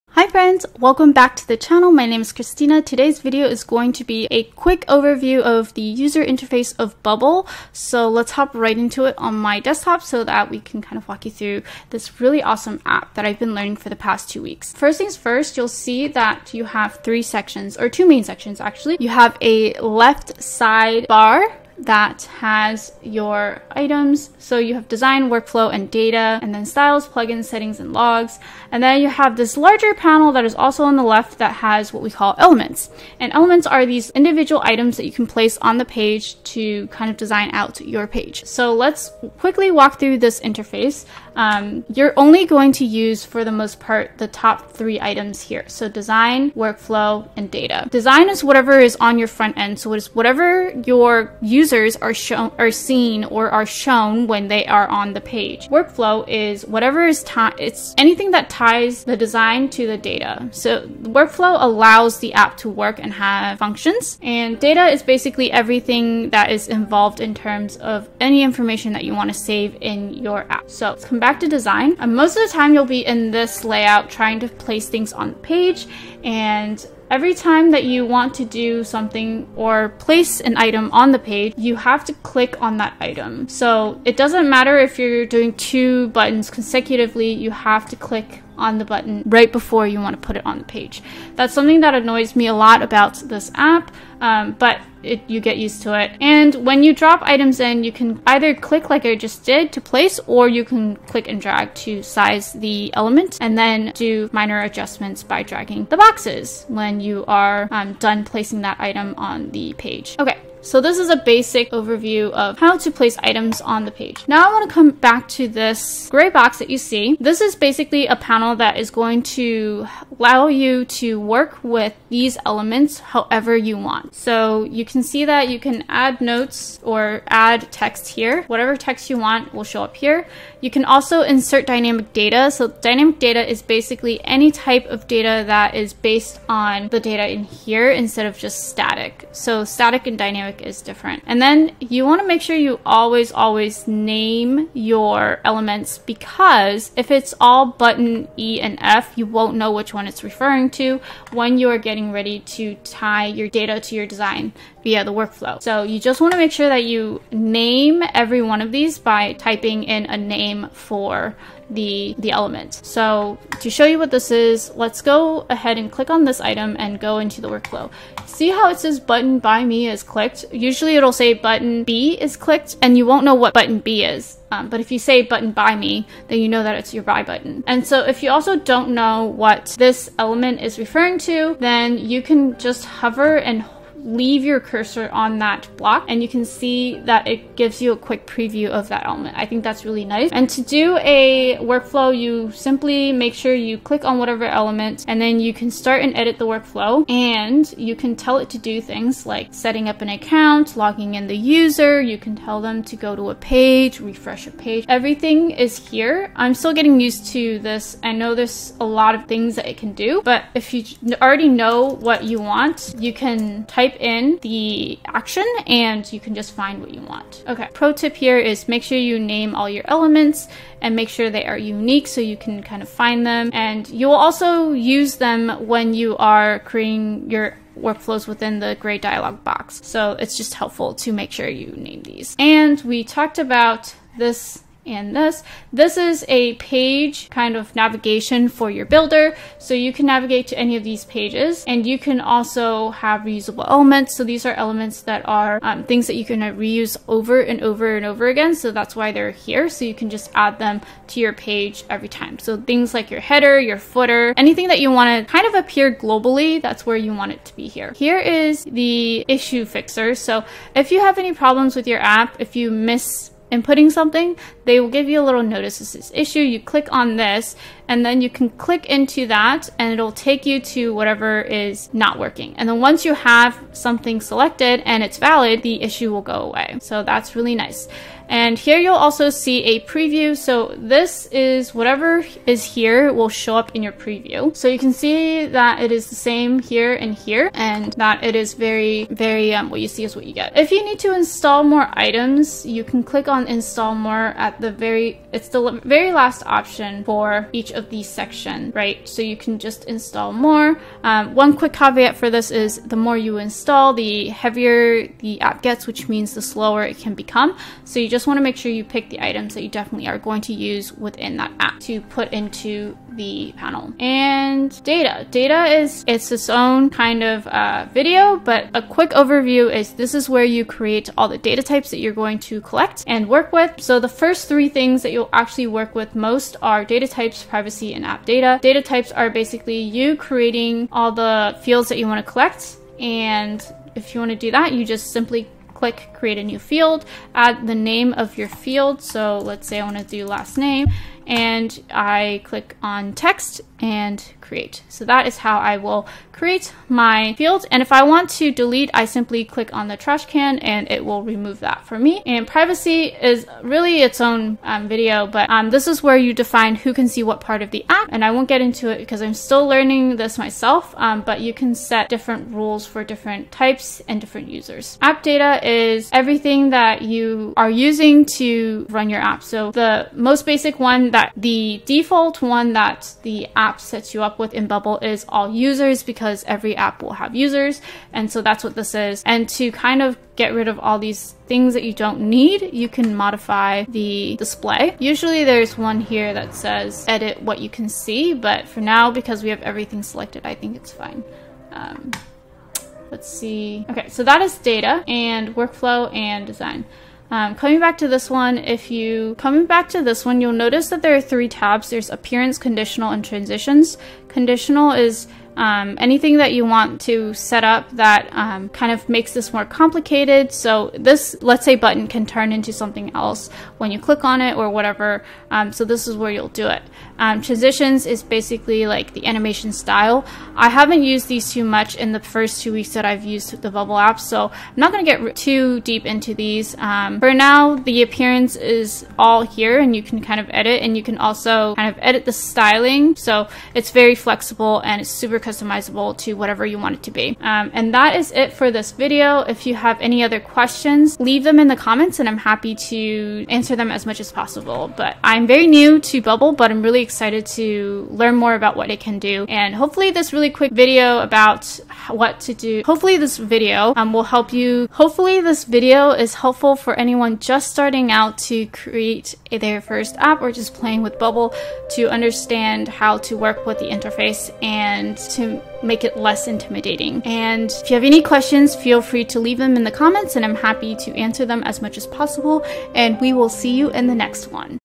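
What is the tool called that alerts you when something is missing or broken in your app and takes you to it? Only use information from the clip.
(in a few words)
issue fixer.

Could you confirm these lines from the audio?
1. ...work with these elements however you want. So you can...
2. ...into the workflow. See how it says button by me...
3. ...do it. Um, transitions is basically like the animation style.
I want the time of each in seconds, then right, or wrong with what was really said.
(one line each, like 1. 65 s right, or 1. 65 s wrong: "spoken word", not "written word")
1. 121 s right
2. 167 s right
3. 416 s right.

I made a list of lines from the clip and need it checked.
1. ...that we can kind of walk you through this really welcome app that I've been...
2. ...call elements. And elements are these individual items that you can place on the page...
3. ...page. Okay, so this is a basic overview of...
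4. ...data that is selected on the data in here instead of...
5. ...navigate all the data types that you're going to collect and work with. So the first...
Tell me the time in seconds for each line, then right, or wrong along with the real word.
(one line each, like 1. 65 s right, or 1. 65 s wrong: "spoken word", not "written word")
1. 10 s wrong: "awesome", not "welcome"
2. 32 s right
3. 109 s right
4. 135 s wrong: "based", not "selected"
5. 320 s wrong: "create", not "navigate".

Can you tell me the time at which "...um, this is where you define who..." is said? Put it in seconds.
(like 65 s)
355 s.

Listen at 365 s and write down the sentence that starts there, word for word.
App data is everything that you are using to run your app.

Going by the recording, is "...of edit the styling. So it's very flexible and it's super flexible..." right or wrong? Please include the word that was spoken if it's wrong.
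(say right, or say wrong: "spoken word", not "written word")
wrong: "customizable", not "flexible".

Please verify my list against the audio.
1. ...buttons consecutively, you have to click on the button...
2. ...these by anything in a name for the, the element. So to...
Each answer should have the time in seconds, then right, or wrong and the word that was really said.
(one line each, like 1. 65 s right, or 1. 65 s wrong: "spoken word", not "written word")
1. 86 s right
2. 158 s wrong: "typing", not "anything".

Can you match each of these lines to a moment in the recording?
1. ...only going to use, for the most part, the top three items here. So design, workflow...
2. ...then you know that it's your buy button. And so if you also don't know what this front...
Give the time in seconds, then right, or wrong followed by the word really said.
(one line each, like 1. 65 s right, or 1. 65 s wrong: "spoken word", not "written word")
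1. 42 s right
2. 176 s wrong: "element", not "front".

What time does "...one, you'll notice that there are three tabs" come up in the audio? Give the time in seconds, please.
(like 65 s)
400 s.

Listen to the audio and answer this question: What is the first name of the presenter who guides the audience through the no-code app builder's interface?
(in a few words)
Christina.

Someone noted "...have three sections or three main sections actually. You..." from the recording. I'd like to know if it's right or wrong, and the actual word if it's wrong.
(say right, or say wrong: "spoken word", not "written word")
wrong: "two", not "three".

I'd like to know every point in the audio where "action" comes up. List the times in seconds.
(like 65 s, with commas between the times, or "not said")
215 s.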